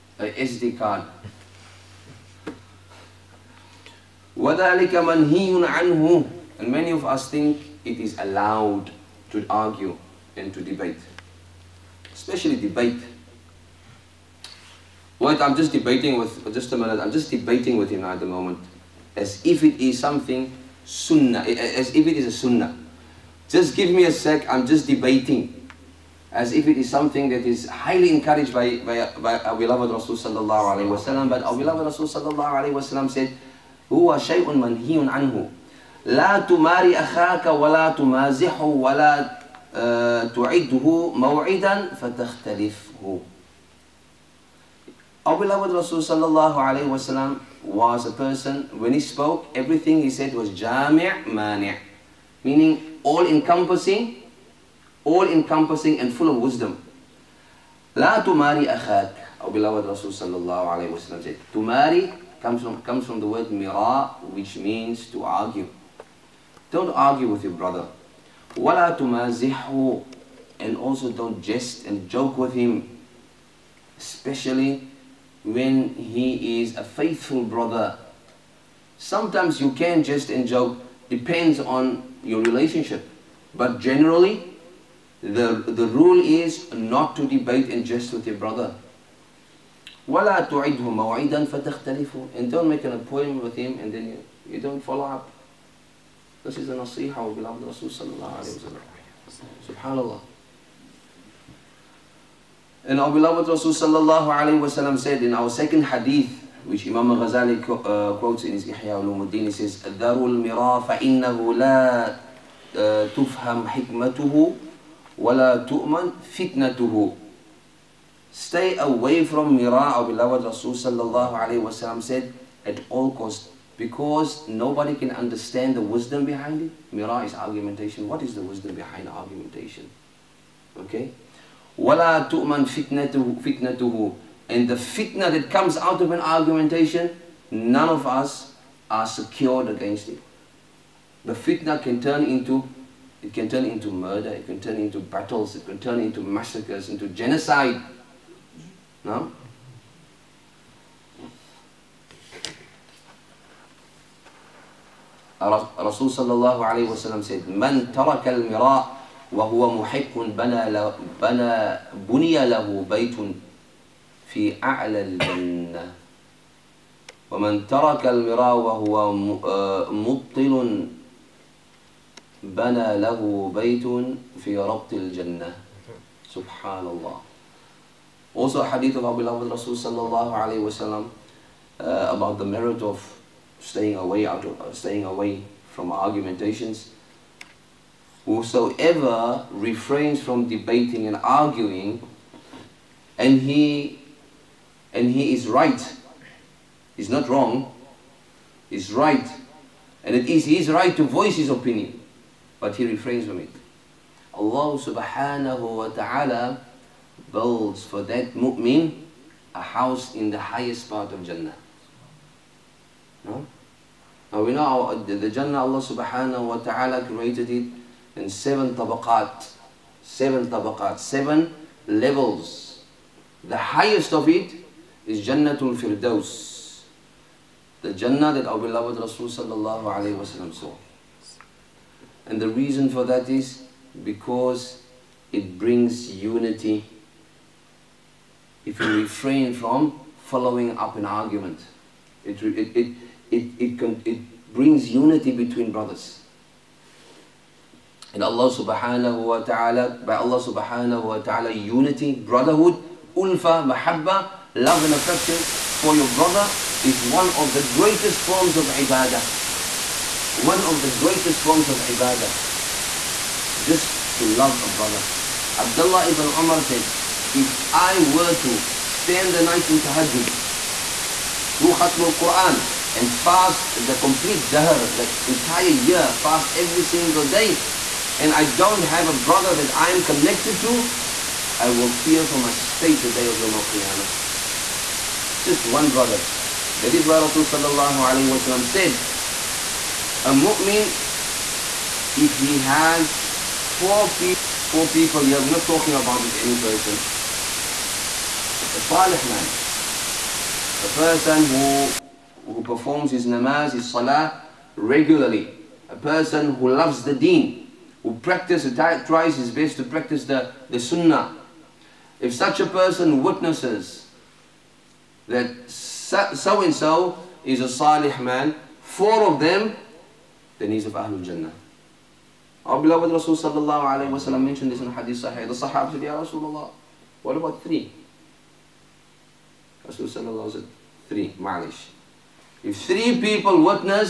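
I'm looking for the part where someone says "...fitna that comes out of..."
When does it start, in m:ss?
2:14.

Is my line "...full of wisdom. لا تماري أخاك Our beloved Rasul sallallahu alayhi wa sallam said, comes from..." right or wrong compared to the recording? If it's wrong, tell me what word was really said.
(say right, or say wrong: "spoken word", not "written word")
right.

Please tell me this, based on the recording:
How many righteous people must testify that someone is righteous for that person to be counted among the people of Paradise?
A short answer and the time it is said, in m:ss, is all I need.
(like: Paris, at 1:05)
4, at 5:18.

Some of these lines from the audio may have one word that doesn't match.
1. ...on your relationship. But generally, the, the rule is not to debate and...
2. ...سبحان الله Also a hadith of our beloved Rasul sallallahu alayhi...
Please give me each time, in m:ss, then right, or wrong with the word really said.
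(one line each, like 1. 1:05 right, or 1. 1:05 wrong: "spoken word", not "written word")
1. 1:21 right
2. 2:56 right.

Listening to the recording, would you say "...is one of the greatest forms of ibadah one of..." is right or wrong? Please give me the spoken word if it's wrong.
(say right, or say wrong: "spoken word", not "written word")
right.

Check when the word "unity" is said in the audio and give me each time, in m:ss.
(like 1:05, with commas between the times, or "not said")
3:56, 4:04, 4:11.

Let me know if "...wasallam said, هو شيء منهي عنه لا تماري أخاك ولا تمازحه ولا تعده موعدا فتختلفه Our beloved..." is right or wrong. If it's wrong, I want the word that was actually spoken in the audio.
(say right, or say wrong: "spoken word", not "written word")
right.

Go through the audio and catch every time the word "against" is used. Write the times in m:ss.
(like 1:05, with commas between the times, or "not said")
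2:19.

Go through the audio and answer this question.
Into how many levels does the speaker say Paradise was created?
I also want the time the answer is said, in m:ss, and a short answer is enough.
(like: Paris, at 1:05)
7, at 3:40.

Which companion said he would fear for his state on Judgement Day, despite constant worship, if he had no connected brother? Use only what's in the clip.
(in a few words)
Abdullah ibn Umar.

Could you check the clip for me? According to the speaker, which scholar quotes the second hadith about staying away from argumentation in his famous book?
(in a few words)
Imam Ghazali.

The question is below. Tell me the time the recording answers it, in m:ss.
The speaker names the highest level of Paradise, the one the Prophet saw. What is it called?
3:45.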